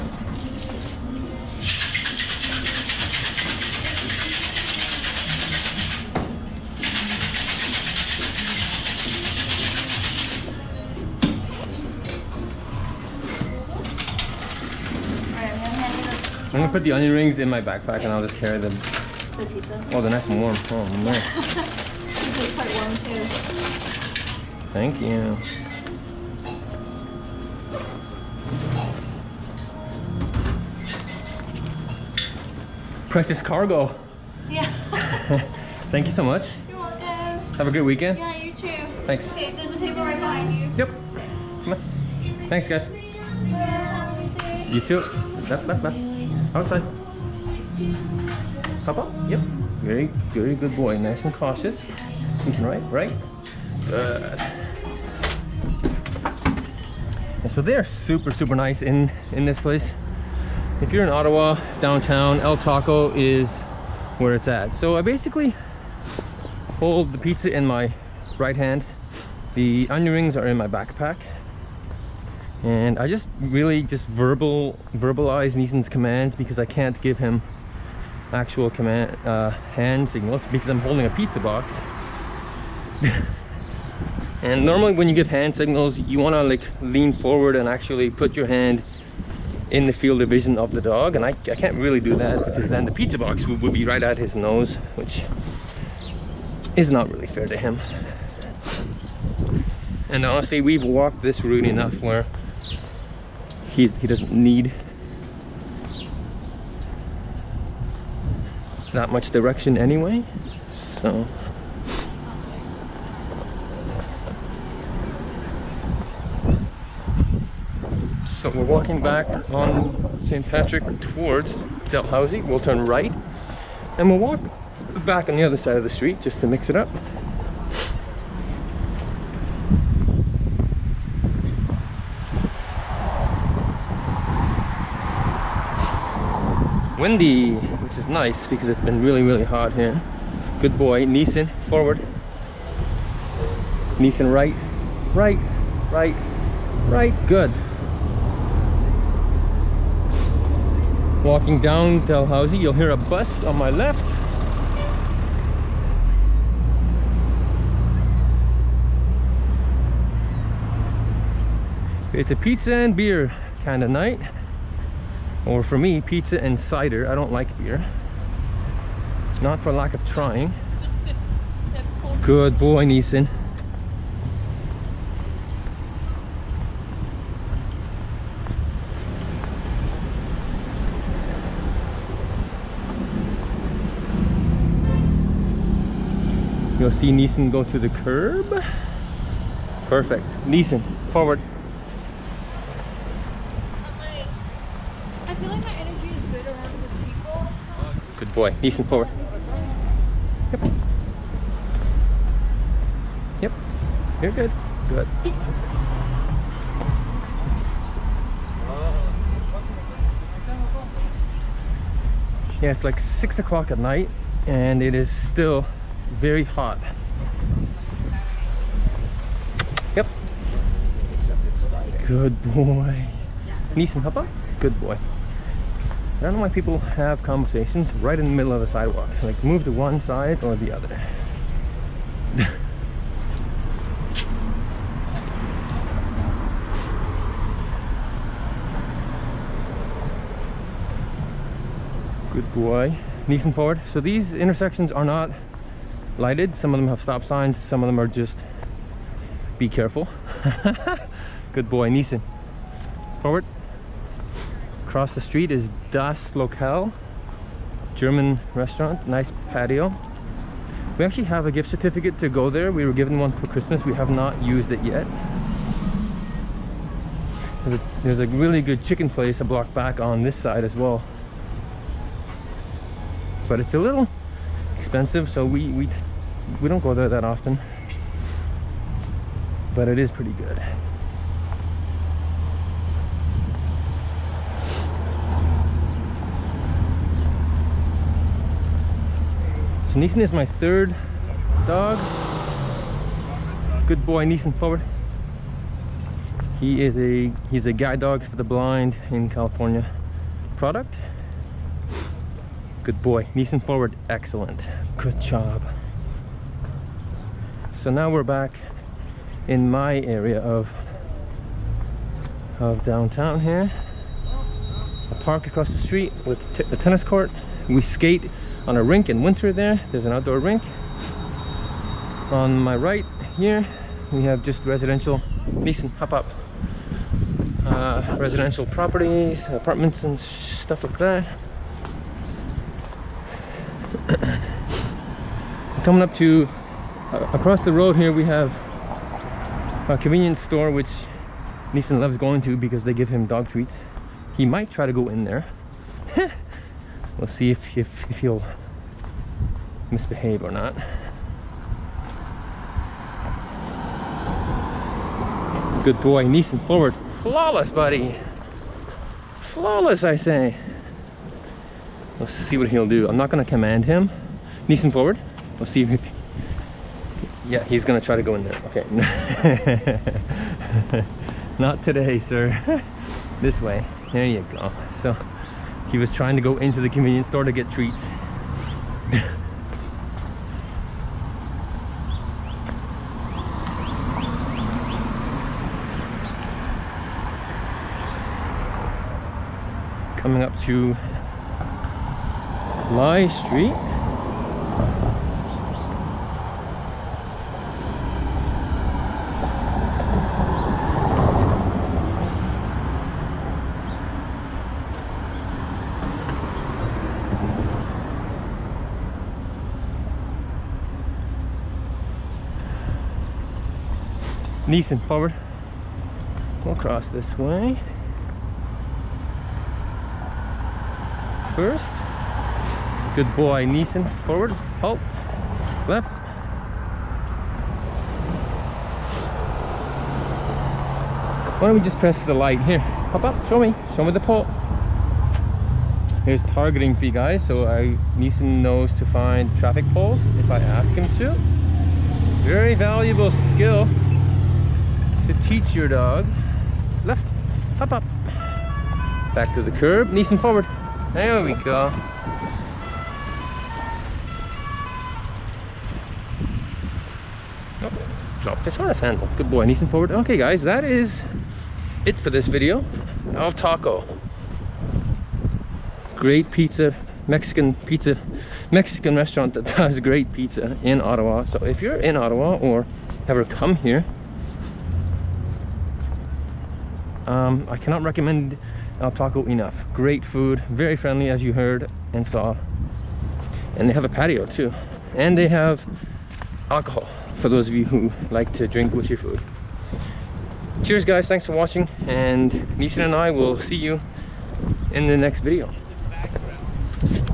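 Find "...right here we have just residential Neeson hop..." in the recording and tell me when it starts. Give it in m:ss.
5:22.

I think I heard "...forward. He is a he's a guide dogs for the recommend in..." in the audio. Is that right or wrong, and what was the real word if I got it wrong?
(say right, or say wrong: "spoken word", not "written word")
wrong: "blind", not "recommend".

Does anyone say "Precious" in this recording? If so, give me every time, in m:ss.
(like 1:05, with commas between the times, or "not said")
0:33.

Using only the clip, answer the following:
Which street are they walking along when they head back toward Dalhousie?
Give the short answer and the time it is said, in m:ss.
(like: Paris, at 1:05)
St. Patrick, at 2:00.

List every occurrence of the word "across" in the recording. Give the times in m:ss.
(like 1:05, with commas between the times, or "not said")
4:14, 5:15, 5:37.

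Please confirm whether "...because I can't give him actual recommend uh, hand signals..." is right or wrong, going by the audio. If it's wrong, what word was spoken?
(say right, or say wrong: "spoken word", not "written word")
wrong: "command", not "recommend".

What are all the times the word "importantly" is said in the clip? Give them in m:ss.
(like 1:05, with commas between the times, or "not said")
not said.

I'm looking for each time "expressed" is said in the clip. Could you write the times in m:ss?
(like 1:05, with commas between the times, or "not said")
not said.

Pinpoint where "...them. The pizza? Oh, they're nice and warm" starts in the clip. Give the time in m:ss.
0:18.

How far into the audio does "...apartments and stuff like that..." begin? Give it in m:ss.
5:29.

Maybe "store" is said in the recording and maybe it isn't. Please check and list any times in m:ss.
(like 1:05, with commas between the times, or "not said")
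5:40, 6:17.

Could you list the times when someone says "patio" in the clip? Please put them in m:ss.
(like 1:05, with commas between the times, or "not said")
4:19, 8:04.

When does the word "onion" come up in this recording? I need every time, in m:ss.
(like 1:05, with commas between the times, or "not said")
0:16, 1:09.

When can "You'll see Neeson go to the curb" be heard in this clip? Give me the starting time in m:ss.
3:06.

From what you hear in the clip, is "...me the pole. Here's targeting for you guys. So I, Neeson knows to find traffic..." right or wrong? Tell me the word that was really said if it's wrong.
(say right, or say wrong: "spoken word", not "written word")
right.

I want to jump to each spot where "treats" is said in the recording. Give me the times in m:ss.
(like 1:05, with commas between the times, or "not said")
5:43, 6:17.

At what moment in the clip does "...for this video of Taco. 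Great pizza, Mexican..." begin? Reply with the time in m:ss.
7:42.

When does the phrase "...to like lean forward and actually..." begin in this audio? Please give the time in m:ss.
1:26.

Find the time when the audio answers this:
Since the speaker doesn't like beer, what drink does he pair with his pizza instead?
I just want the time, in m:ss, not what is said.
2:46.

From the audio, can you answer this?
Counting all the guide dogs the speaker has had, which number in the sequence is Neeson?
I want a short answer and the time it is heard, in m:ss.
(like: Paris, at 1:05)
Third, at 4:50.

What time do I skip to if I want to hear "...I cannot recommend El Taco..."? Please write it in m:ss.
7:57.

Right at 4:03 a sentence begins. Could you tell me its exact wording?
So these intersections are not lighted.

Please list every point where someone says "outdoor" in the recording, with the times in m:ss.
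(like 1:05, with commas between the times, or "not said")
5:20.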